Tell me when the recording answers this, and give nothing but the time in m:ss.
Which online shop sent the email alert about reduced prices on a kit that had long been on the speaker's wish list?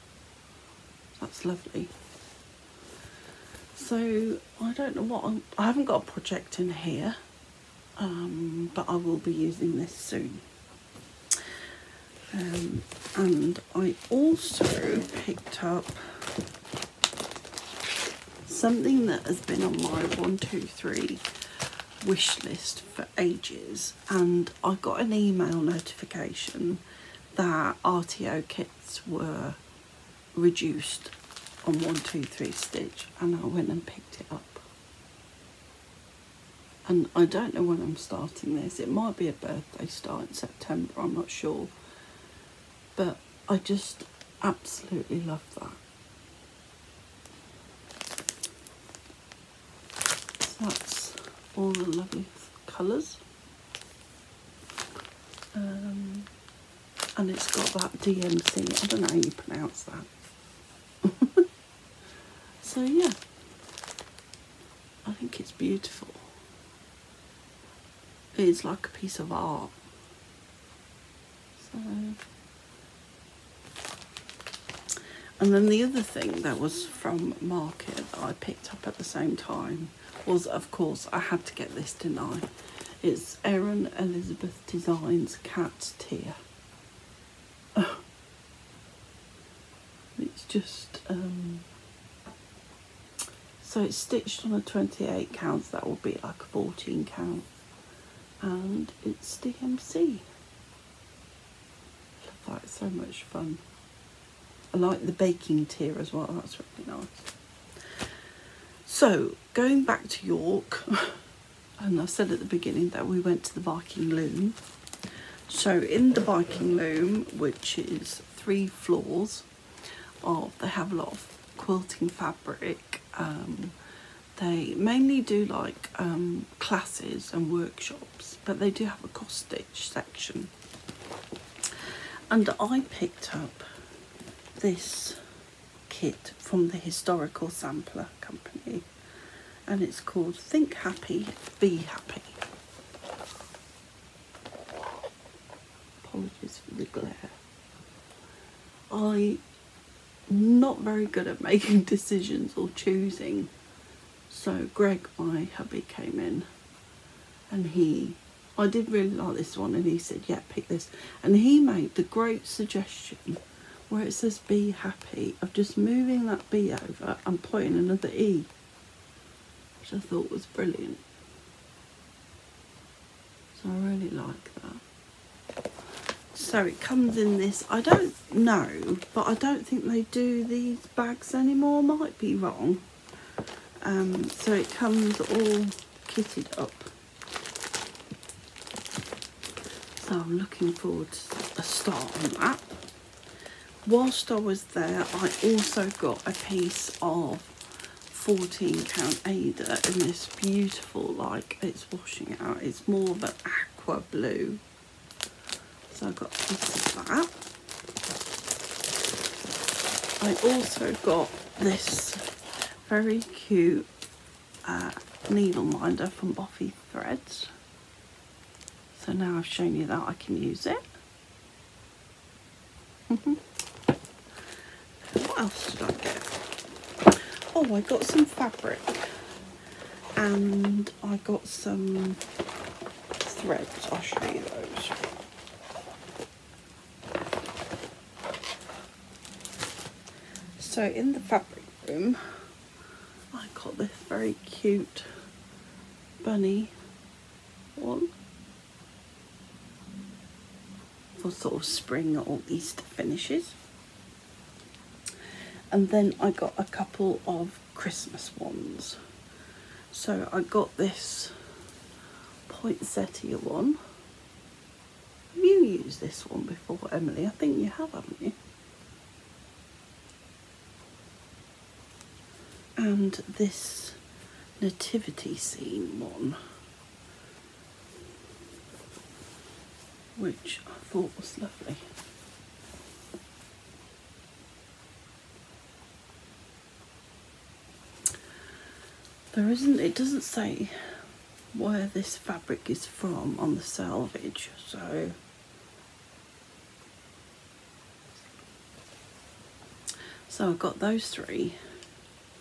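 0:31.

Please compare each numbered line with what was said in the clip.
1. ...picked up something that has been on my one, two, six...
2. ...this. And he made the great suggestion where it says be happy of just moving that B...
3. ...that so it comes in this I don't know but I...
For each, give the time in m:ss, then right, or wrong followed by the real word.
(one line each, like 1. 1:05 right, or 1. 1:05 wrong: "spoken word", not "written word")
1. 0:15 wrong: "three", not "six"
2. 2:40 right
3. 2:54 right.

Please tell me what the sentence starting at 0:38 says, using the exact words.
It might be a birthday start in September, I'm not sure but I just absolutely love that.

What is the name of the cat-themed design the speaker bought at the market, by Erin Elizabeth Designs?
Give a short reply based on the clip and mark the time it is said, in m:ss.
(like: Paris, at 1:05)
Cat Tier, at 1:25.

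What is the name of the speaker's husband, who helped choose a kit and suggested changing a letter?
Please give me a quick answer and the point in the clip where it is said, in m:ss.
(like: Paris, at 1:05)
Greg, at 2:34.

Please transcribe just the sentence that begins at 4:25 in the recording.
Have you used this one before, Emily?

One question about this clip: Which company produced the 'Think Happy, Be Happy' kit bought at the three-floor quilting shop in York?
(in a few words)
Historical Sampler Company.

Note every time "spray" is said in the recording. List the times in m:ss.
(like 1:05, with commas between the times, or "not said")
not said.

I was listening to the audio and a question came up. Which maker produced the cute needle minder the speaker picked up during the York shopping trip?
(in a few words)
Boffy Threads.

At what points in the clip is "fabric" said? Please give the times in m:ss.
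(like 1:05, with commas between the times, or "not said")
2:02, 3:48, 4:01, 4:52.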